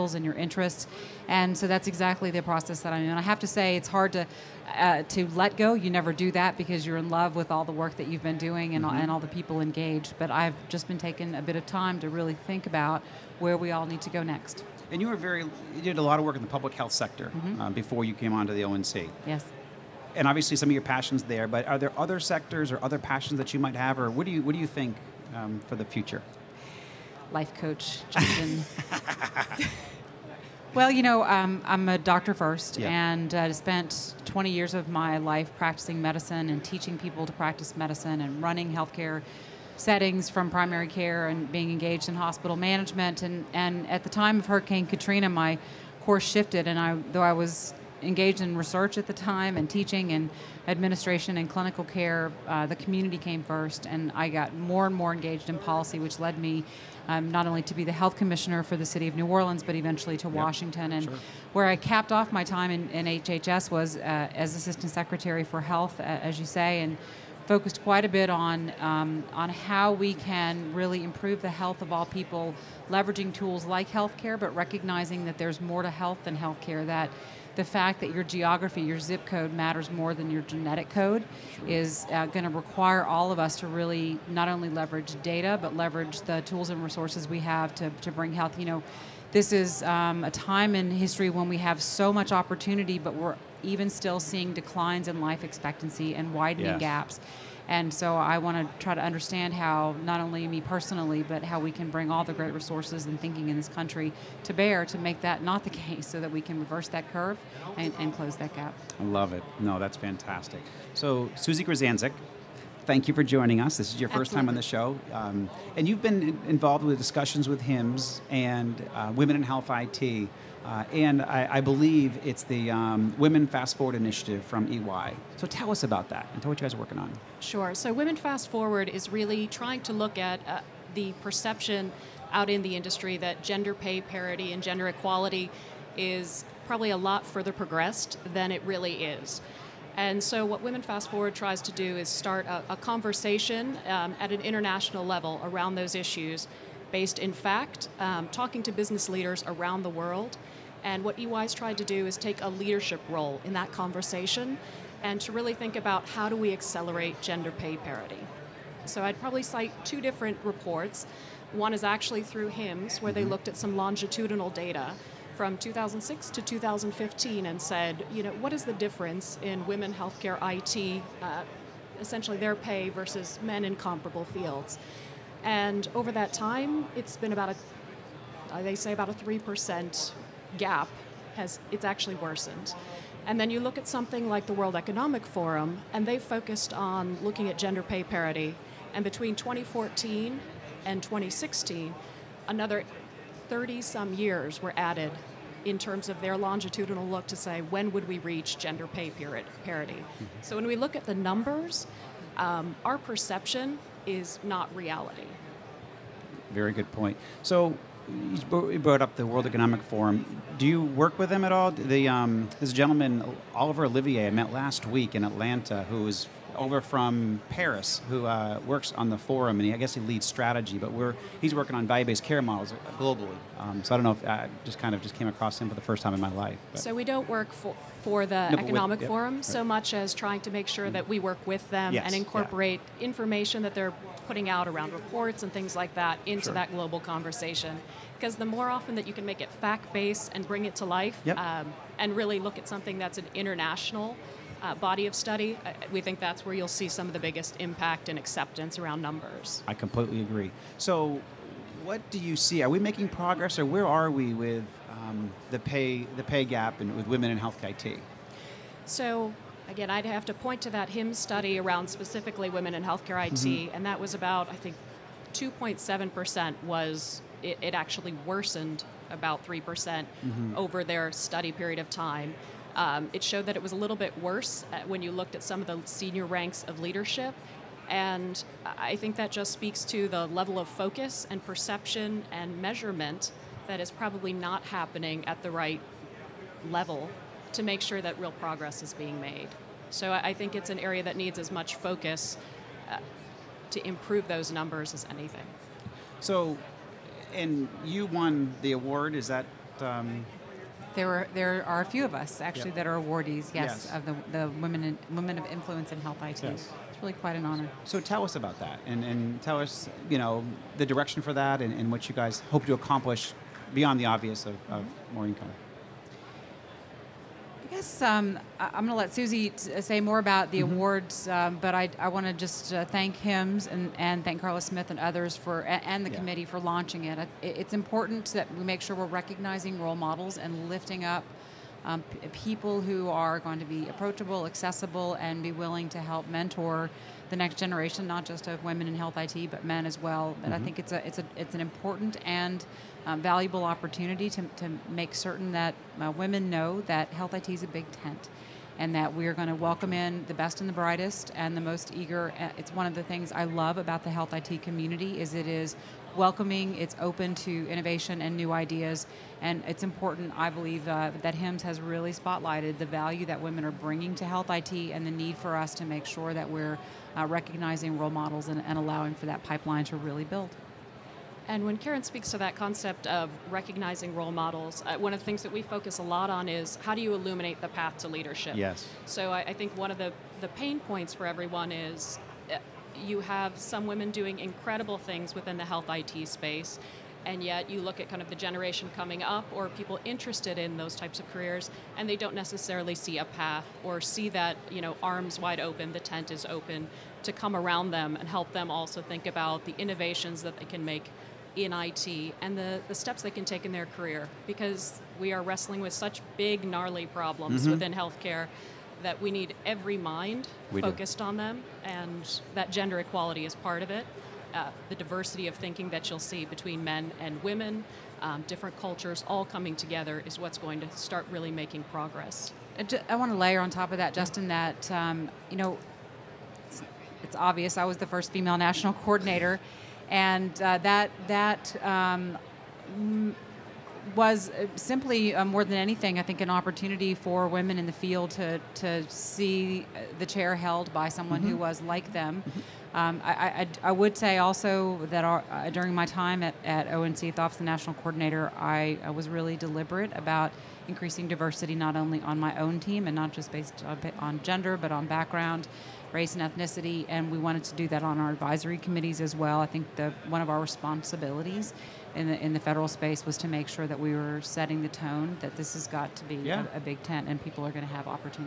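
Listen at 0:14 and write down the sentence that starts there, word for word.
And you were very, you did a lot of work in the public health sector mm-hmm.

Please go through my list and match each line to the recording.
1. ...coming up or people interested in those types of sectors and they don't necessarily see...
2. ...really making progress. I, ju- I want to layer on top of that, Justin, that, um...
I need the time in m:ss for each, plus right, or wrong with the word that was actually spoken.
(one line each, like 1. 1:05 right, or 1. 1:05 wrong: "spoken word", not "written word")
1. 6:28 wrong: "careers", not "sectors"
2. 7:01 right.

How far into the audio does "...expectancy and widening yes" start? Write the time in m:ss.
1:35.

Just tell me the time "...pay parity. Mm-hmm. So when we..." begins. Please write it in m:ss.
3:18.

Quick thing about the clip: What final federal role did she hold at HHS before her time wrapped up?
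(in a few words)
Assistant Secretary for Health.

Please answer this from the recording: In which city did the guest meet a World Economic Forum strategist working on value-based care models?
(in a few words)
Atlanta.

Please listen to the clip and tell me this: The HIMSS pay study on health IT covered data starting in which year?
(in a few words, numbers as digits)
2006.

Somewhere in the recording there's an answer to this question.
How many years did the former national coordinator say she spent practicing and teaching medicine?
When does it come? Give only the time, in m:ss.
0:34.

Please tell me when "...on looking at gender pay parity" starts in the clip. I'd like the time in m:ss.
3:06.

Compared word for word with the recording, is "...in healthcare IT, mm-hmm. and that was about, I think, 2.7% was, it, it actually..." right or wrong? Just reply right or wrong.
right.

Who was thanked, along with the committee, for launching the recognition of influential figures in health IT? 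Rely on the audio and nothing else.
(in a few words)
Carla Smith.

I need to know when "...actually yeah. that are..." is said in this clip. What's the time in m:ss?
5:02.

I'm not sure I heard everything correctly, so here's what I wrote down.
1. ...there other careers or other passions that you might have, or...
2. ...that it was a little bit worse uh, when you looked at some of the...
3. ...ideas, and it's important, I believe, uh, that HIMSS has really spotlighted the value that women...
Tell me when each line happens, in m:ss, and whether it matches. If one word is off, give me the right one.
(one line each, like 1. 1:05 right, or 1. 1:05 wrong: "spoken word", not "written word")
1. 0:21 wrong: "sectors", not "careers"
2. 4:33 right
3. 5:58 right.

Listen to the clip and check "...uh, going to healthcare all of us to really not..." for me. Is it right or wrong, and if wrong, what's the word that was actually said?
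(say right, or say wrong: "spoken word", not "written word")
wrong: "require", not "healthcare".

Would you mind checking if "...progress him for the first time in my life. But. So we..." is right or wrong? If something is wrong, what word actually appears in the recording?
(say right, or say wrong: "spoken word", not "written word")
wrong: "across", not "progress".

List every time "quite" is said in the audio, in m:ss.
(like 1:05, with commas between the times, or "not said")
1:07, 5:07.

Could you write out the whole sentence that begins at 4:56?
So, and you won the award, is that?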